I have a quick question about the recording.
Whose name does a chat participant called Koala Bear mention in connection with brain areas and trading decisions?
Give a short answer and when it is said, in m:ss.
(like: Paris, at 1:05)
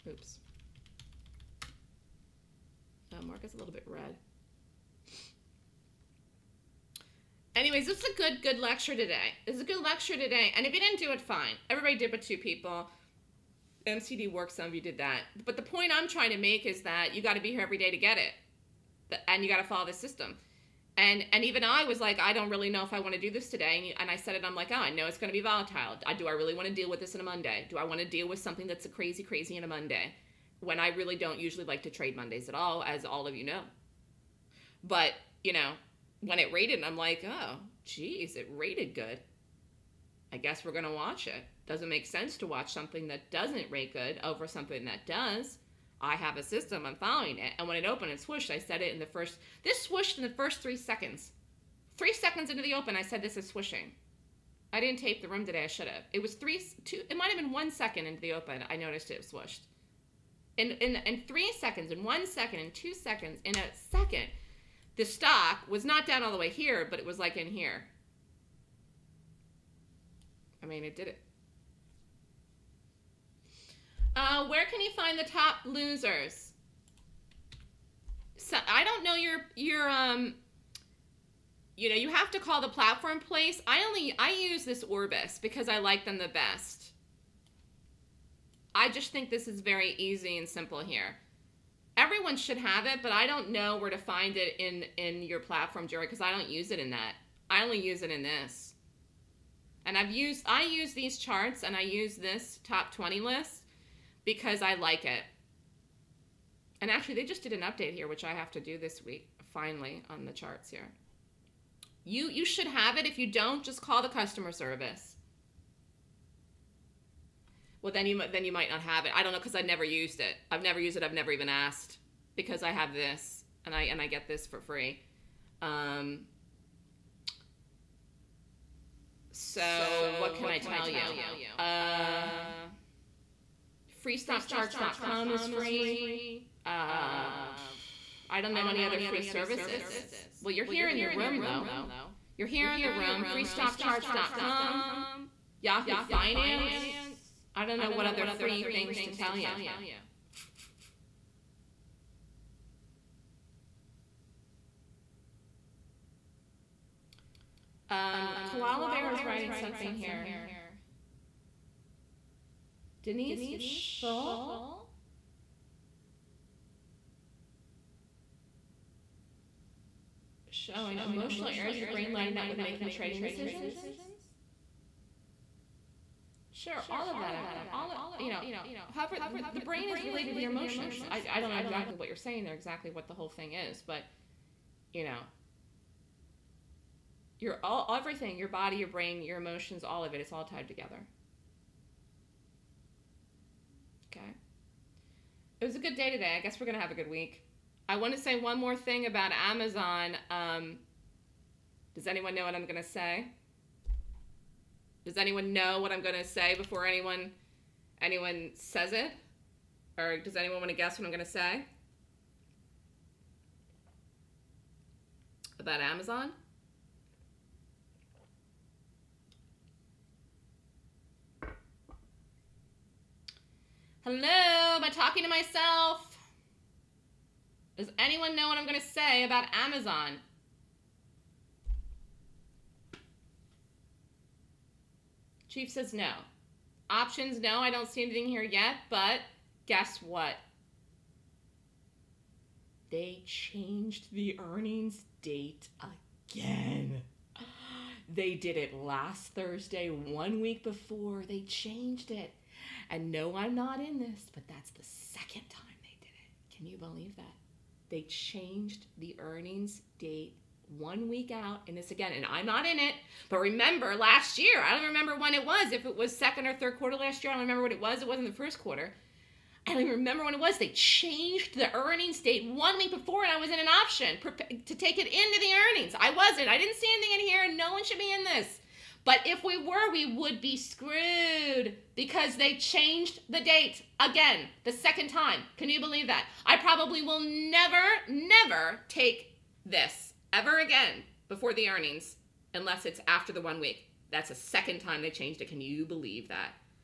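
Denise Shull, at 2:43.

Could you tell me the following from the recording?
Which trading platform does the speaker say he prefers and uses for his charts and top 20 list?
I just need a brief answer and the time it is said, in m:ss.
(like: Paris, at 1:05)
Orbis, at 1:24.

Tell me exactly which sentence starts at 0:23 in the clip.
And, you, and I said it, I'm like, oh, I know it's going to be volatile.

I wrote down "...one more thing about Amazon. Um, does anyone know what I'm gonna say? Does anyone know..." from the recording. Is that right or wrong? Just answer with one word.
right.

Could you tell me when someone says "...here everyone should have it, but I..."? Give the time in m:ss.
1:30.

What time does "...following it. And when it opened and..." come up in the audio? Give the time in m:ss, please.
0:46.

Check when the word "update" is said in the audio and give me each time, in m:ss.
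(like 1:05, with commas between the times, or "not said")
1:47.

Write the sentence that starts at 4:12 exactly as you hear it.
And no, I'm not in this, but that's the second time they did it.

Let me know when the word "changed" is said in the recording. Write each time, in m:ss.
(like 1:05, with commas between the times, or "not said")
4:03, 4:11, 4:18, 4:30, 4:42, 4:55.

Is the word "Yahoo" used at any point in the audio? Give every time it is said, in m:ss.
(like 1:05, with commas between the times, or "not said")
2:25.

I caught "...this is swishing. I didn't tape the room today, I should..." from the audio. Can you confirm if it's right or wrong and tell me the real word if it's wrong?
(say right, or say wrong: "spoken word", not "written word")
right.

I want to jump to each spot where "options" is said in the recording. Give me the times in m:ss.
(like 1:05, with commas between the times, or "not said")
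3:56, 4:33.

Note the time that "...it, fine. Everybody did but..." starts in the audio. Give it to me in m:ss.
0:11.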